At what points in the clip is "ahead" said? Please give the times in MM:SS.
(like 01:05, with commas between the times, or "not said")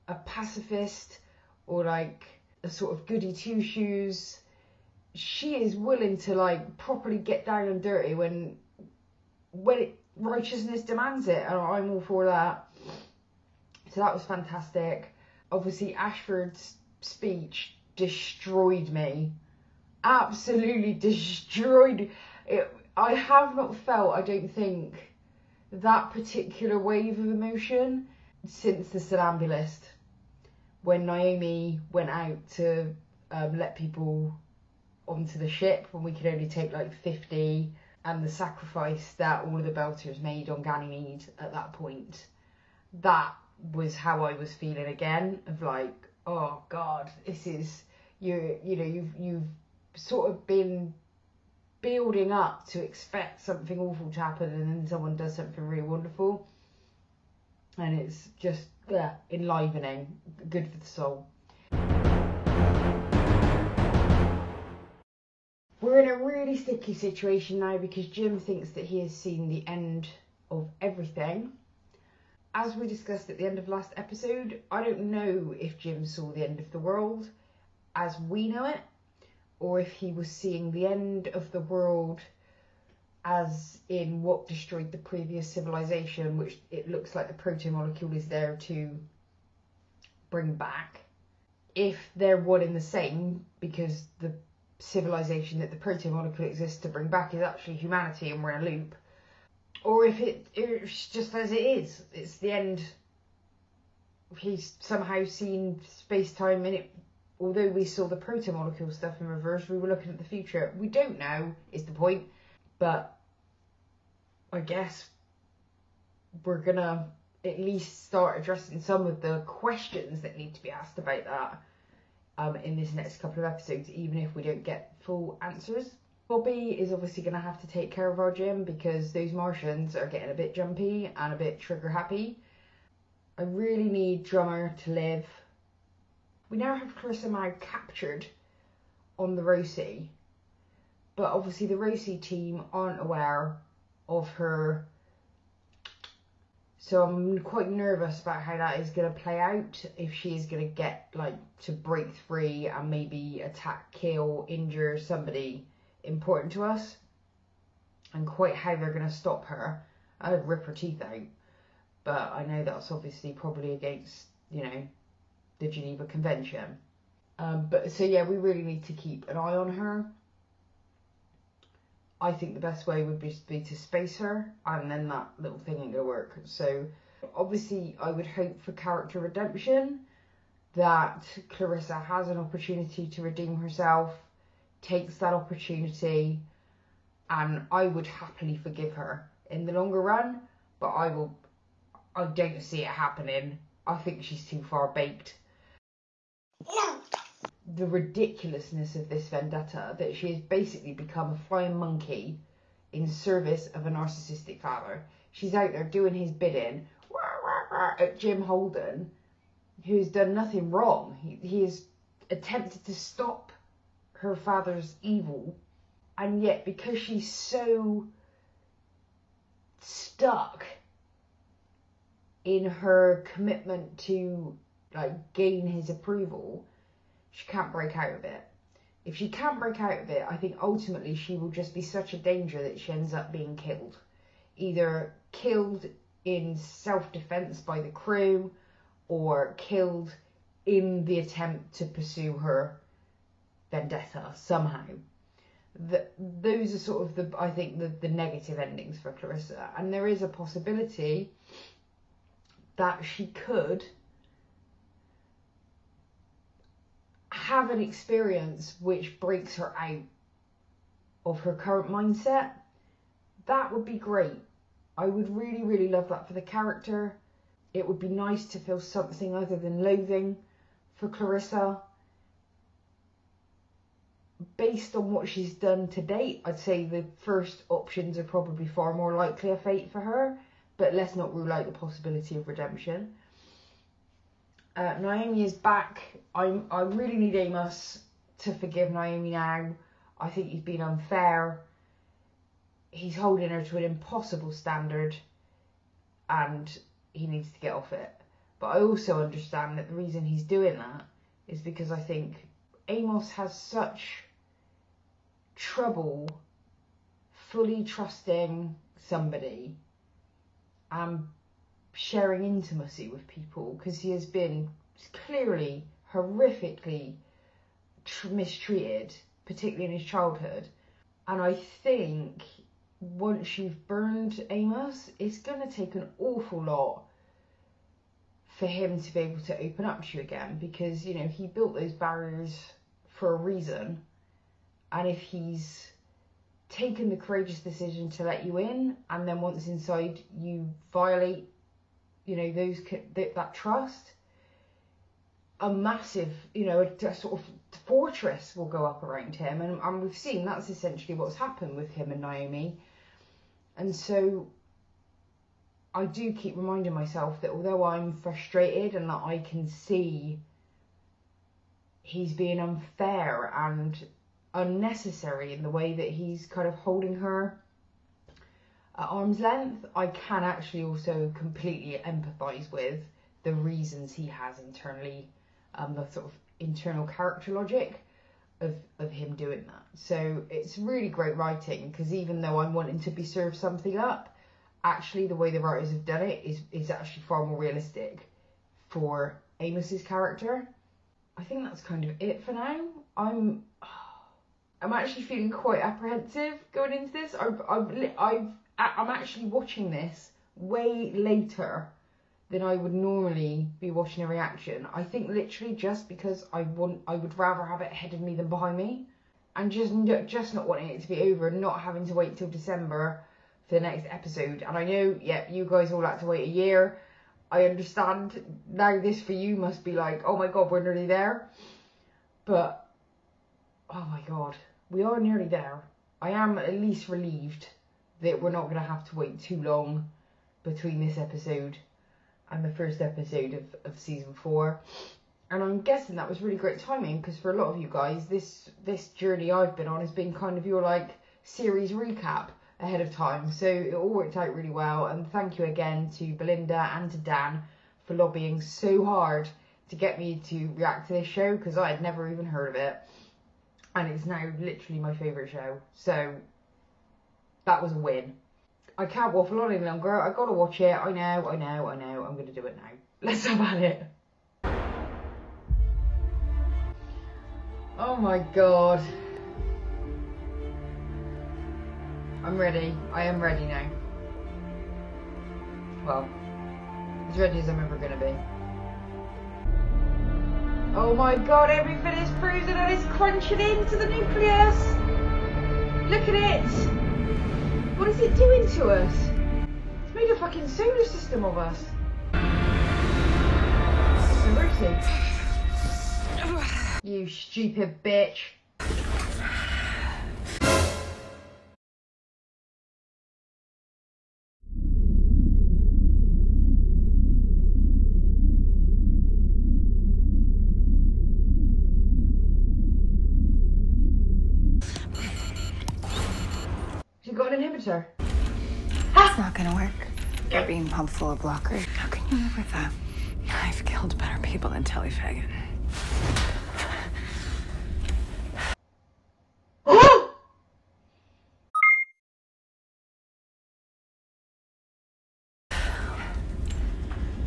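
06:47, 07:22.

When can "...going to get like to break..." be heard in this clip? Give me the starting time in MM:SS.
02:30.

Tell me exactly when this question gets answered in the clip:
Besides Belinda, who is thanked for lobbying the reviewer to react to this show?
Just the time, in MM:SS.
07:27.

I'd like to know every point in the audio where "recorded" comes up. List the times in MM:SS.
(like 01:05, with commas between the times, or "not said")
not said.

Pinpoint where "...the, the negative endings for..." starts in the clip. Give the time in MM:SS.
04:07.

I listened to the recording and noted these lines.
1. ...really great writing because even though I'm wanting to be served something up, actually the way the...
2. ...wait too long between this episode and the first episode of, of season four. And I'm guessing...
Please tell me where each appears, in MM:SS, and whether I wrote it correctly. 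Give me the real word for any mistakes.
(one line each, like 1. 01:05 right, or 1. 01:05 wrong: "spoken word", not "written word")
1. 06:20 right
2. 07:09 right.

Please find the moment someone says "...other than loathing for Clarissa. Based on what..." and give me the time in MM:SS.
04:29.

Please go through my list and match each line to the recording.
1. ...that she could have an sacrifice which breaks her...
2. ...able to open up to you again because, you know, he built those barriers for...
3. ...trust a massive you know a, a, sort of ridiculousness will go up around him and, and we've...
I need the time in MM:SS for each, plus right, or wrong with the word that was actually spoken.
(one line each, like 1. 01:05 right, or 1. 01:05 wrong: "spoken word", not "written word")
1. 04:12 wrong: "experience", not "sacrifice"
2. 05:29 right
3. 05:43 wrong: "fortress", not "ridiculousness".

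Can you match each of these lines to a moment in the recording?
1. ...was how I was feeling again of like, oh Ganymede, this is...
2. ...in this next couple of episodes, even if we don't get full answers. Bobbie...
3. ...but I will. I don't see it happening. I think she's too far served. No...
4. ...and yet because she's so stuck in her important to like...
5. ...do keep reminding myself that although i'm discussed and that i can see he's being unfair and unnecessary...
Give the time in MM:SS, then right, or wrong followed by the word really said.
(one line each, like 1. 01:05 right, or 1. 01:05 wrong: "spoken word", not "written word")
1. 00:43 wrong: "God", not "Ganymede"
2. 02:02 right
3. 03:10 wrong: "baked", not "served"
4. 03:36 wrong: "commitment", not "important"
5. 05:56 wrong: "frustrated", not "discussed".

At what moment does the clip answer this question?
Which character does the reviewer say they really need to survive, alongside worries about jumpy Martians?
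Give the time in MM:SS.
02:14.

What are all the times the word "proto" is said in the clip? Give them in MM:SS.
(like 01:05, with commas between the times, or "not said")
01:27, 01:35, 01:48.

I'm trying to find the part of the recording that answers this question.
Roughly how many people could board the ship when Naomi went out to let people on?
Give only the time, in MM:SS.
00:37.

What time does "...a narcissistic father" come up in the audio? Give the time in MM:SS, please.
03:23.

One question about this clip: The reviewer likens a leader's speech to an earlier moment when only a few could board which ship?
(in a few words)
Somnambulist.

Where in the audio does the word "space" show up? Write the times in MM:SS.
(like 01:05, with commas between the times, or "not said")
01:45, 02:53.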